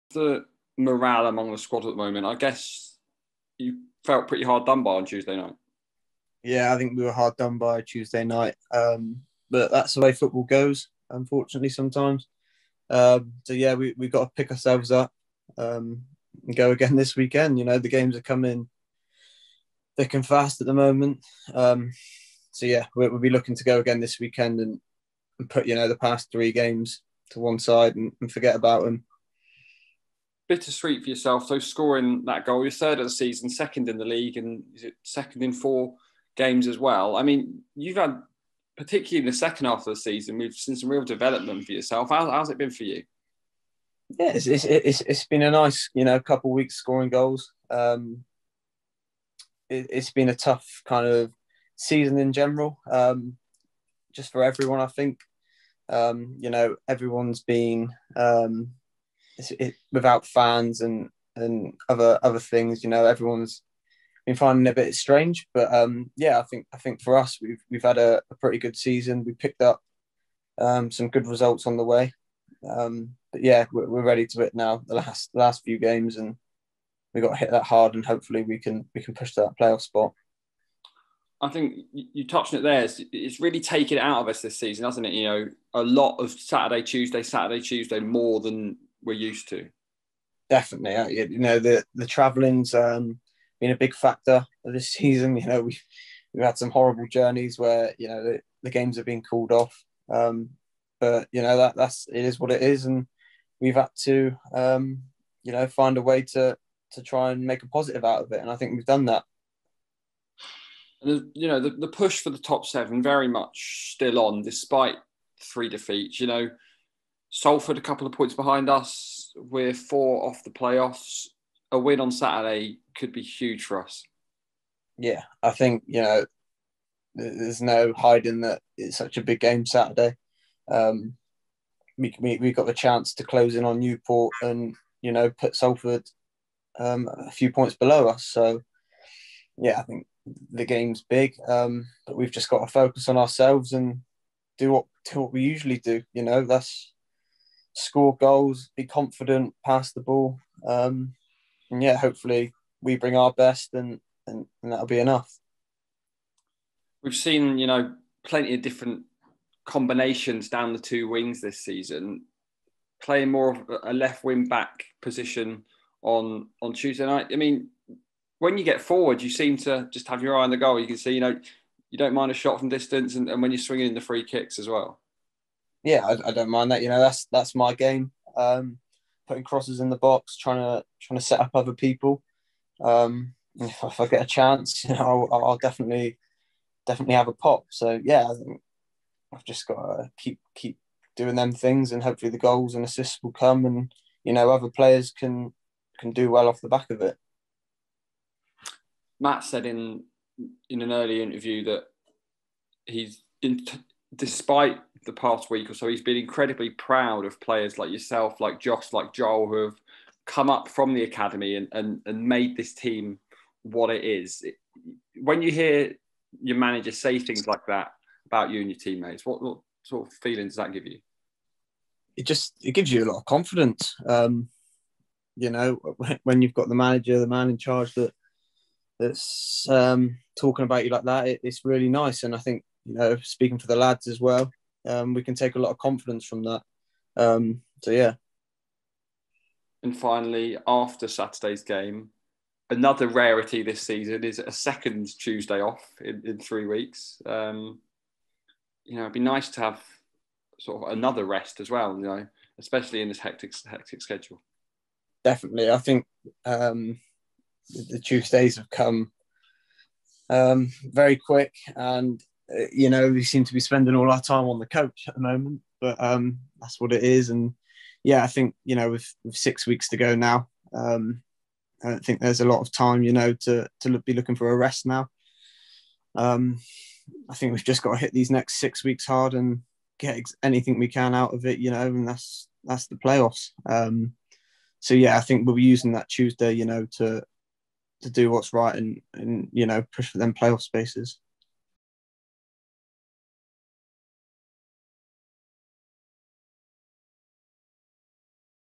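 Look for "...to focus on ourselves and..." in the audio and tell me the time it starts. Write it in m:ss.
2:22.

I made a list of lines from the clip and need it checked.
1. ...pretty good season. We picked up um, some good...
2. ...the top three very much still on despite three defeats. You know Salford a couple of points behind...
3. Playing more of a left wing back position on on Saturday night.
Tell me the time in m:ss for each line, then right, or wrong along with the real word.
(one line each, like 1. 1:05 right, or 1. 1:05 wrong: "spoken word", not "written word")
1. 1:08 right
2. 1:52 wrong: "seven", not "three"
3. 2:43 wrong: "Tuesday", not "Saturday".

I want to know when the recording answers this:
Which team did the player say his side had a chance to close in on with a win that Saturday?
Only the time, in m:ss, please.
2:13.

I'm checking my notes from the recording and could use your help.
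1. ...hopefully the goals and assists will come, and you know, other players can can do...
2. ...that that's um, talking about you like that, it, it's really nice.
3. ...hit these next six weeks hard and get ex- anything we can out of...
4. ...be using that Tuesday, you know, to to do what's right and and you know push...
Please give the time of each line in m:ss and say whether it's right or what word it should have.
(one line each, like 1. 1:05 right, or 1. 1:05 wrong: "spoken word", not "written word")
1. 3:12 right
2. 3:47 right
3. 4:37 right
4. 4:45 right.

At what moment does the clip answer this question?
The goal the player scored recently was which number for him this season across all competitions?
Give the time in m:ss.
0:32.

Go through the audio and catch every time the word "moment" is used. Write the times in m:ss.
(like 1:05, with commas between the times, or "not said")
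0:01, 0:20, 4:25.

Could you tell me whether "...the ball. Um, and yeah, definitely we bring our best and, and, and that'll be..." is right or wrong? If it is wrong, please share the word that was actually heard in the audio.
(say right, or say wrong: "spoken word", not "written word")
wrong: "hopefully", not "definitely".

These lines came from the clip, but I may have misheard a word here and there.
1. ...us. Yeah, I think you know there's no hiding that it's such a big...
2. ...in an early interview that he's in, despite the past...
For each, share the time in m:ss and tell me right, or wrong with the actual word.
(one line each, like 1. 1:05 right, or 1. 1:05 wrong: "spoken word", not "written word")
1. 2:03 right
2. 3:20 right.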